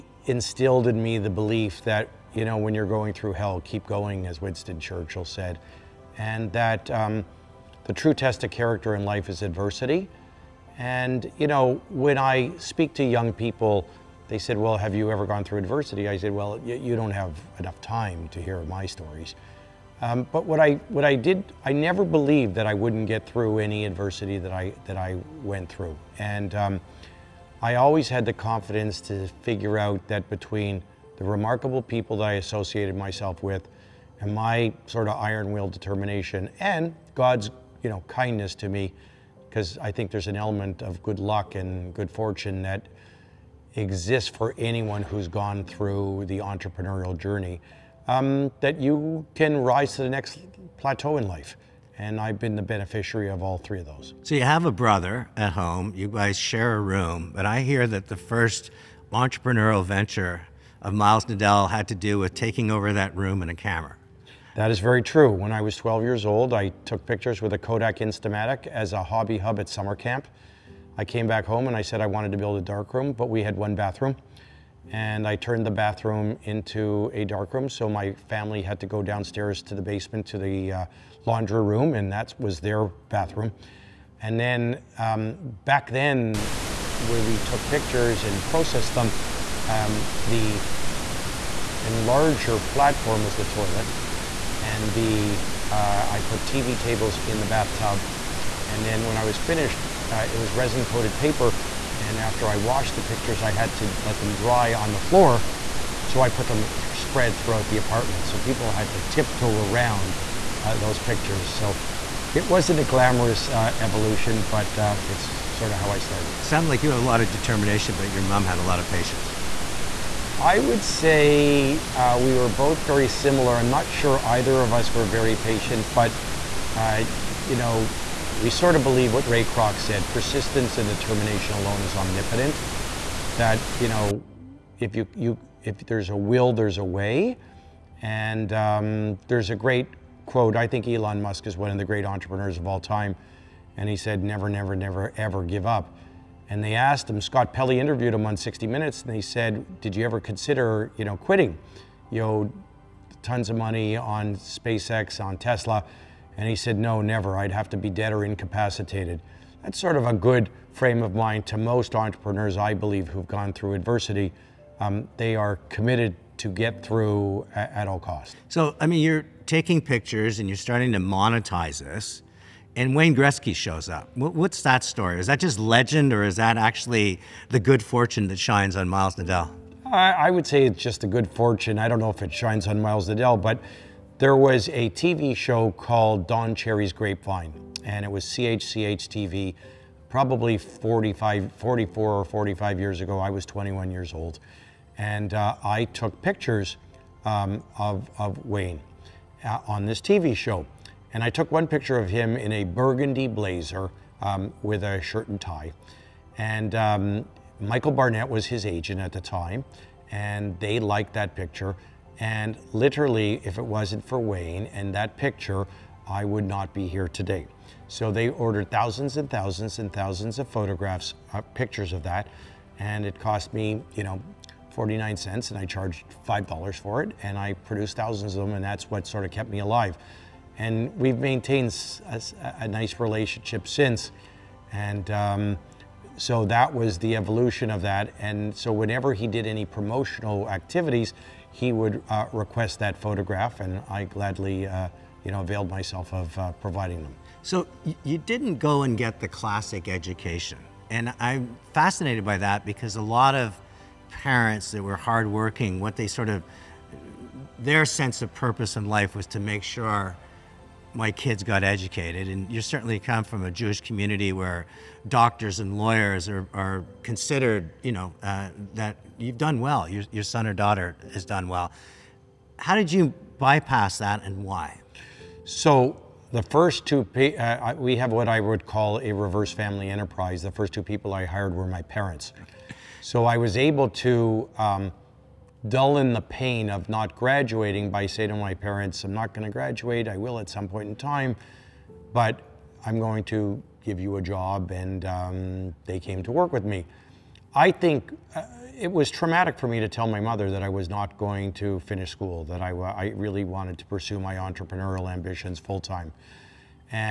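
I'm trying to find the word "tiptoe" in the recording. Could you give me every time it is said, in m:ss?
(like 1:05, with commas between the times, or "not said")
1:49.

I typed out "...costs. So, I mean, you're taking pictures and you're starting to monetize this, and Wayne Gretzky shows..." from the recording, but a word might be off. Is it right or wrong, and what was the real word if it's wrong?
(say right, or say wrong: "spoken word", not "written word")
right.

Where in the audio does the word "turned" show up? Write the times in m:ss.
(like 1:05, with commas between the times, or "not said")
1:15.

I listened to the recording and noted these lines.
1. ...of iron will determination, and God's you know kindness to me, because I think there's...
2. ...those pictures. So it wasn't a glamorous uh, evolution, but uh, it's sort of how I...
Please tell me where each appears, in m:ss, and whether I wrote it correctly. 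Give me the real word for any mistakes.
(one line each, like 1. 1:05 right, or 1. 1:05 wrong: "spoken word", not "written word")
1. 0:35 right
2. 1:50 right.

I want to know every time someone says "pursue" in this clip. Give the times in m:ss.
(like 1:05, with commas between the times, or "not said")
5:03.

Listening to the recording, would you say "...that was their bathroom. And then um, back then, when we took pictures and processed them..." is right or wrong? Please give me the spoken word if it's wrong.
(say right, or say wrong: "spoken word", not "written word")
right.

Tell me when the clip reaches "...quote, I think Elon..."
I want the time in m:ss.
2:20.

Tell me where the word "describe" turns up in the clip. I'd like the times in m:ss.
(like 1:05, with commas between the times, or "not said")
not said.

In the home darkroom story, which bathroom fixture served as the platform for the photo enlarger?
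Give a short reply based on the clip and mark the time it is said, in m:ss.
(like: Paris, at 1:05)
the toilet, at 1:33.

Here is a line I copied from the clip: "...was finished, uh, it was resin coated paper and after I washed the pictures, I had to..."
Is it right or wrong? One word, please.
right.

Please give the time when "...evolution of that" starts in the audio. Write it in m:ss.
3:57.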